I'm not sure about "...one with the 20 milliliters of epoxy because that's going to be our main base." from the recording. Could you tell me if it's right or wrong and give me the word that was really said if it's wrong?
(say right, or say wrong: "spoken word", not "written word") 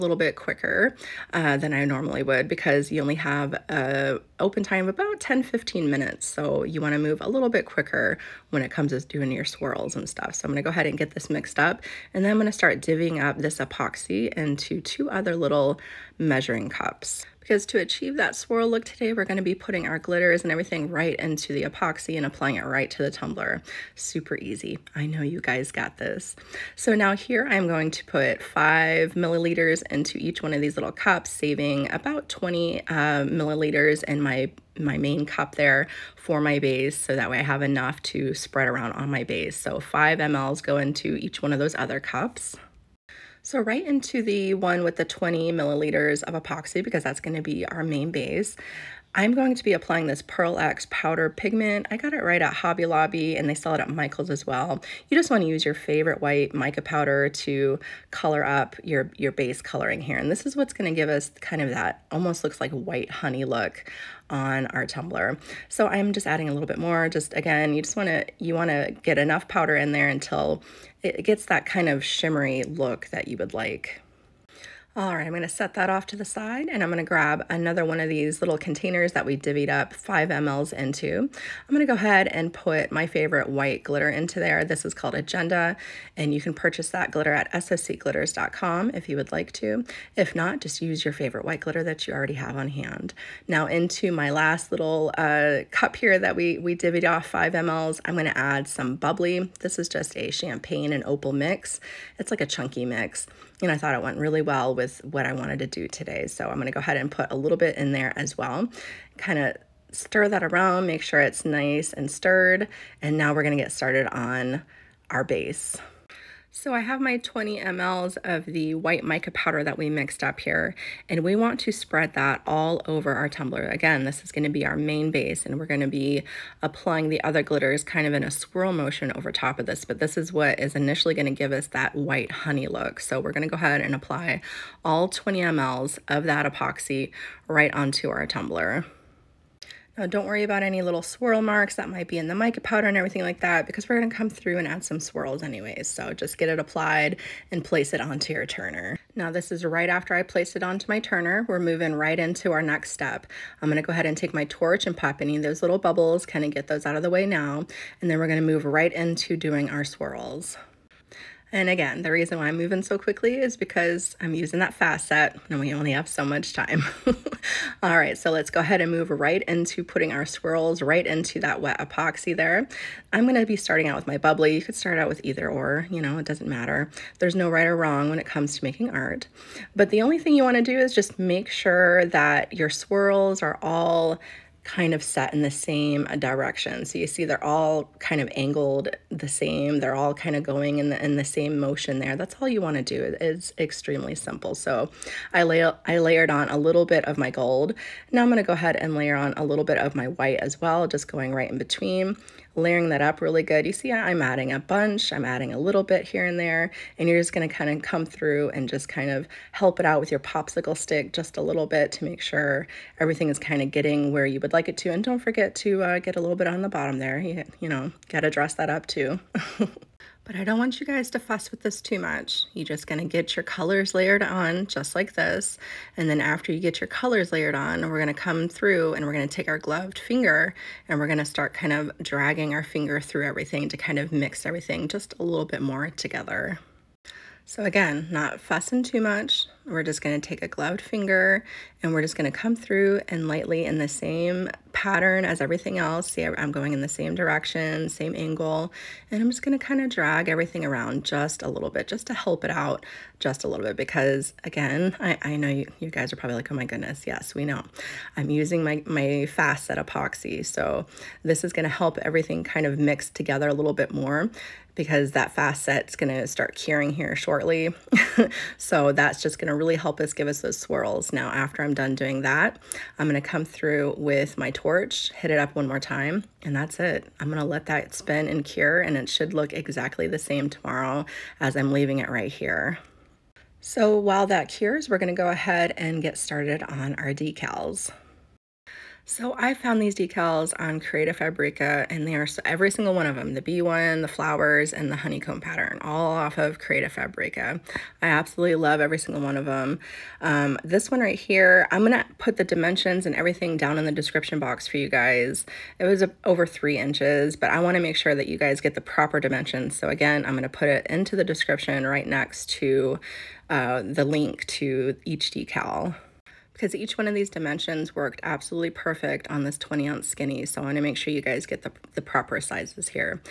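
right.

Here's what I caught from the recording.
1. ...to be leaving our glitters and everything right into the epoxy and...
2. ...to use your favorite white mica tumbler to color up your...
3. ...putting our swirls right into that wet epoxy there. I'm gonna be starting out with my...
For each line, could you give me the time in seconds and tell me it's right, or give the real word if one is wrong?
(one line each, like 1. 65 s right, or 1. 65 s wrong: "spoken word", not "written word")
1. 19 s wrong: "putting", not "leaving"
2. 55 s wrong: "powder", not "tumbler"
3. 169 s right.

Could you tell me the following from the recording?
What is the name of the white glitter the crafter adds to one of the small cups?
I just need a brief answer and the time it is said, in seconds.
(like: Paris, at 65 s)
Agenda, at 85 s.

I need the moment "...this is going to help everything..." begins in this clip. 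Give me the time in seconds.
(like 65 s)
261 s.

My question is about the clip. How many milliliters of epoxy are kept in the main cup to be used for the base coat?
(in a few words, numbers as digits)
20.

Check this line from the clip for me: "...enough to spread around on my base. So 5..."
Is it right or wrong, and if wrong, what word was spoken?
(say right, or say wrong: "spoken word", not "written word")
right.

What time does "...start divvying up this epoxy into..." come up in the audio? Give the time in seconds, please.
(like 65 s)
12 s.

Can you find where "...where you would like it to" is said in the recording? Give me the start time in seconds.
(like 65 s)
214 s.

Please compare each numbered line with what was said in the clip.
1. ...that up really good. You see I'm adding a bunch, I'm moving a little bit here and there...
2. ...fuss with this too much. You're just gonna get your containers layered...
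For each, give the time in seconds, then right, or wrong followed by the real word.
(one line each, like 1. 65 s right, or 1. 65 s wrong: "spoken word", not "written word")
1. 202 s wrong: "adding", not "moving"
2. 221 s wrong: "colors", not "containers".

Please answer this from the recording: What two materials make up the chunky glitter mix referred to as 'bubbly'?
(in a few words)
champagne and opal.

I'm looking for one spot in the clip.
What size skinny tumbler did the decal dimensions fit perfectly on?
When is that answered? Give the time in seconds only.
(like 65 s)
319 s.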